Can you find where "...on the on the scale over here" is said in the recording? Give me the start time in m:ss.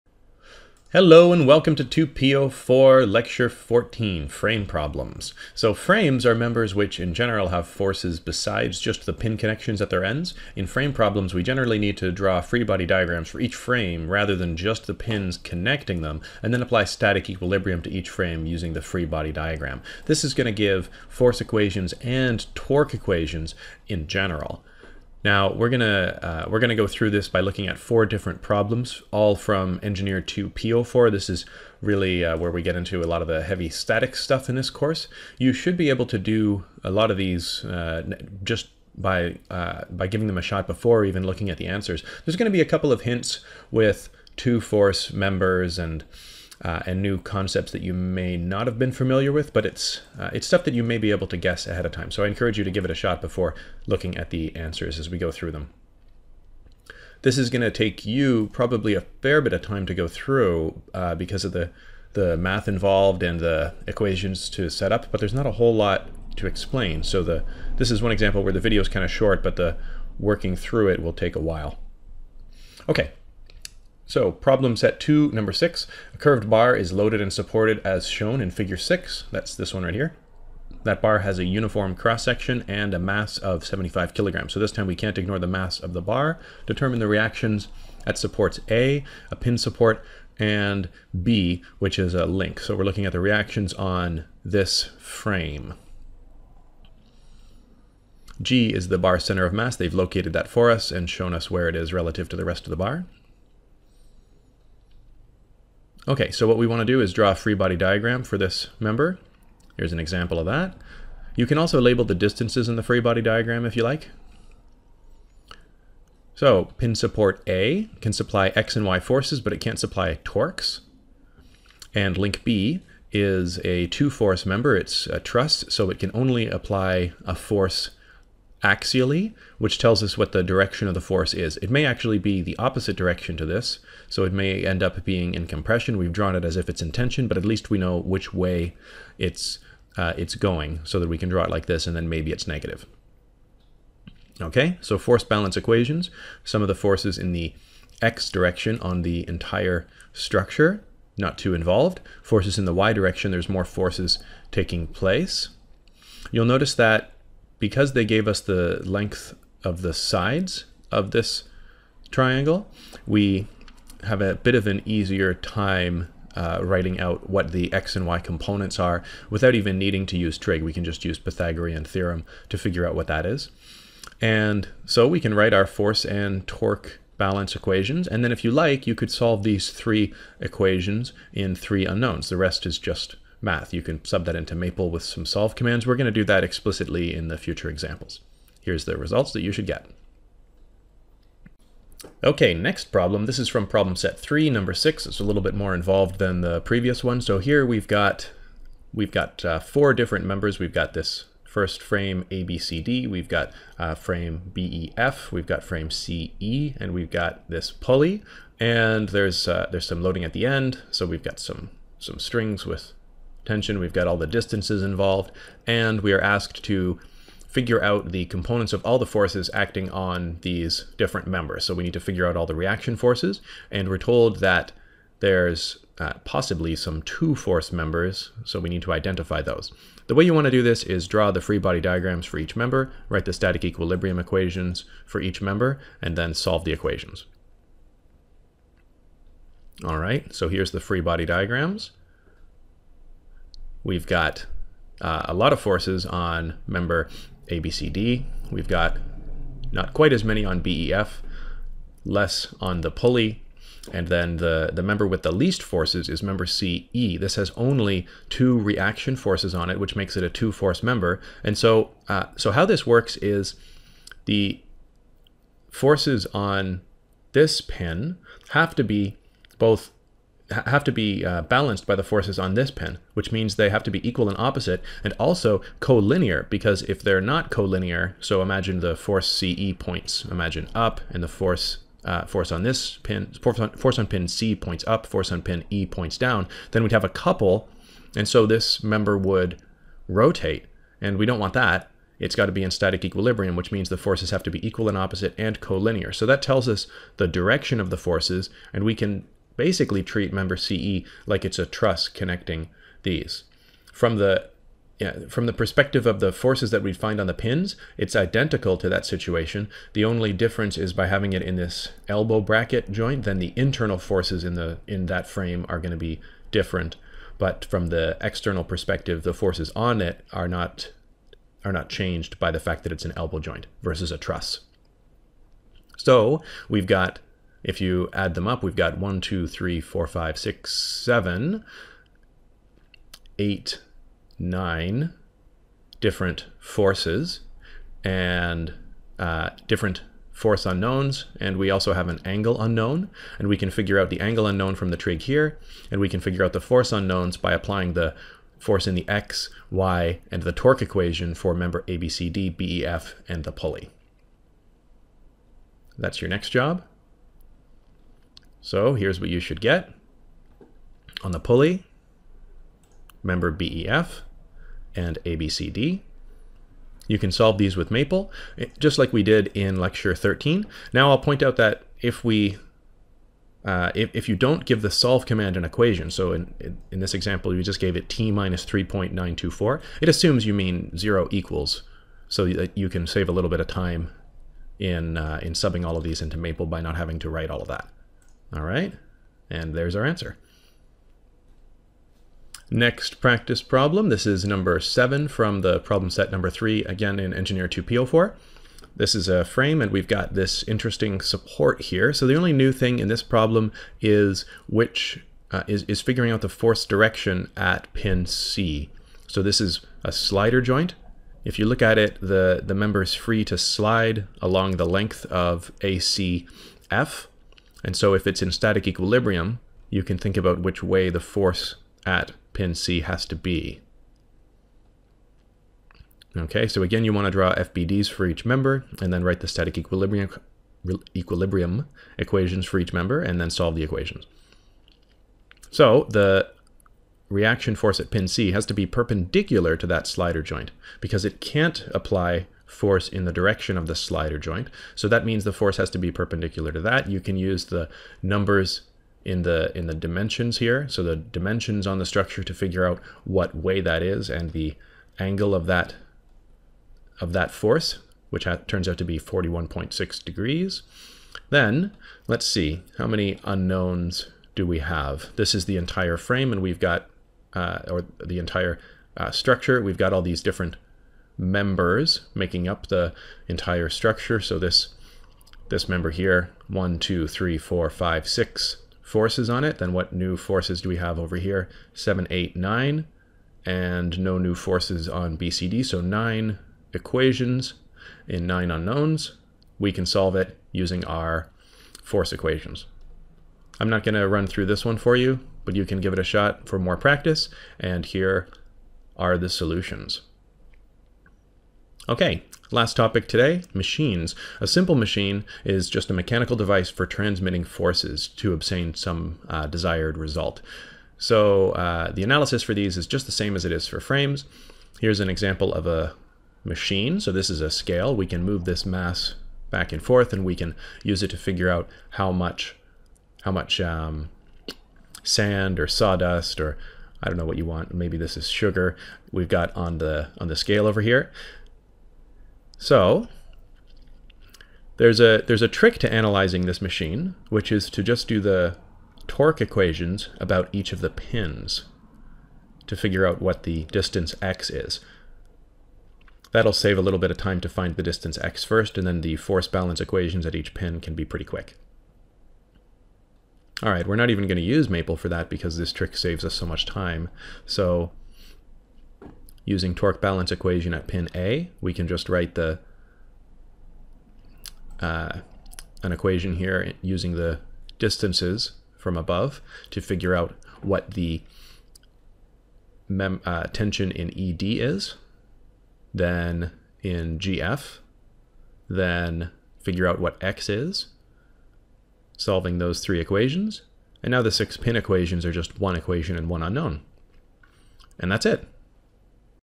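8:49.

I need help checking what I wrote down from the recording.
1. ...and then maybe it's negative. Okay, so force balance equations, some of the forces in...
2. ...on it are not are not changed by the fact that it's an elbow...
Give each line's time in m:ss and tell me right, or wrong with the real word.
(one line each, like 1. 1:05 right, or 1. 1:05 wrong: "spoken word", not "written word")
1. 2:21 right
2. 5:19 right.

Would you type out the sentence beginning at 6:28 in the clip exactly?
All right, and there's our answer.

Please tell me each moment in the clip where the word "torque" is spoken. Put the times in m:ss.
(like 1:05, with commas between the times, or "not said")
0:22, 2:00, 2:56, 5:50, 8:59, 9:19.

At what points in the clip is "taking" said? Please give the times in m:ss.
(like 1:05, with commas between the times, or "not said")
2:34.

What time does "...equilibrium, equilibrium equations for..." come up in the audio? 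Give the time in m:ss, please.
7:09.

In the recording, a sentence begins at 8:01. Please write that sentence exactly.
Seven, eight, nine, and no new forces on BCD.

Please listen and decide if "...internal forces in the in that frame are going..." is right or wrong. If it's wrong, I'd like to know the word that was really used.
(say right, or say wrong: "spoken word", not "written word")
right.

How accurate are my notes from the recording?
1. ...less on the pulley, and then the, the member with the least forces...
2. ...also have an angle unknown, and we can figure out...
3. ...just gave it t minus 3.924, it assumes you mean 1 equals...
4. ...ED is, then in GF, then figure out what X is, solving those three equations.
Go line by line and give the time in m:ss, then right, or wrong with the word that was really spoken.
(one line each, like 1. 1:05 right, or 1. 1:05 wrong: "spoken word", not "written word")
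1. 4:12 right
2. 5:41 right
3. 6:17 wrong: "0", not "1"
4. 9:34 right.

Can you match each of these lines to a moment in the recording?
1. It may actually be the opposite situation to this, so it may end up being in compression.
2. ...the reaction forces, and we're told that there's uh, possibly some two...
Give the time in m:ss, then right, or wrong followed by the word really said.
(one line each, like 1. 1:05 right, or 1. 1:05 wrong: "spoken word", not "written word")
1. 2:11 wrong: "direction", not "situation"
2. 3:42 right.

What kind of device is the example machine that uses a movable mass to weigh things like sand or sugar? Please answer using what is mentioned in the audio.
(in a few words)
a scale.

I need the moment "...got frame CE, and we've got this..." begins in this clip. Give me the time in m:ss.
3:25.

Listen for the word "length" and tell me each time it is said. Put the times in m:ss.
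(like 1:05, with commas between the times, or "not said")
2:38, 6:54.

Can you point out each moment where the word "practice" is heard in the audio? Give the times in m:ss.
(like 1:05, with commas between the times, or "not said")
6:33, 8:16.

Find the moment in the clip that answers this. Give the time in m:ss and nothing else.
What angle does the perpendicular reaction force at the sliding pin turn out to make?
7:39.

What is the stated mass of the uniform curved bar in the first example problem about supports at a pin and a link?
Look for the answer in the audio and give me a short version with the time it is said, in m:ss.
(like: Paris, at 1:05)
75 kg, at 1:23.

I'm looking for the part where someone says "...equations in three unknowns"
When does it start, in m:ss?
3:00.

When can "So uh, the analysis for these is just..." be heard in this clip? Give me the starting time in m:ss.
8:31.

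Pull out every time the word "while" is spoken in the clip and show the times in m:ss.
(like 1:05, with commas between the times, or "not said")
1:11.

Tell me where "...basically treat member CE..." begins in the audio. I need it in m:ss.
4:59.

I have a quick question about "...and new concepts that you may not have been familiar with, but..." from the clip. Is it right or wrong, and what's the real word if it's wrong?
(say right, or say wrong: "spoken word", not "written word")
right.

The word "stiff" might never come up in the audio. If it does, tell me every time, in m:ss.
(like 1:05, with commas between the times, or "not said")
not said.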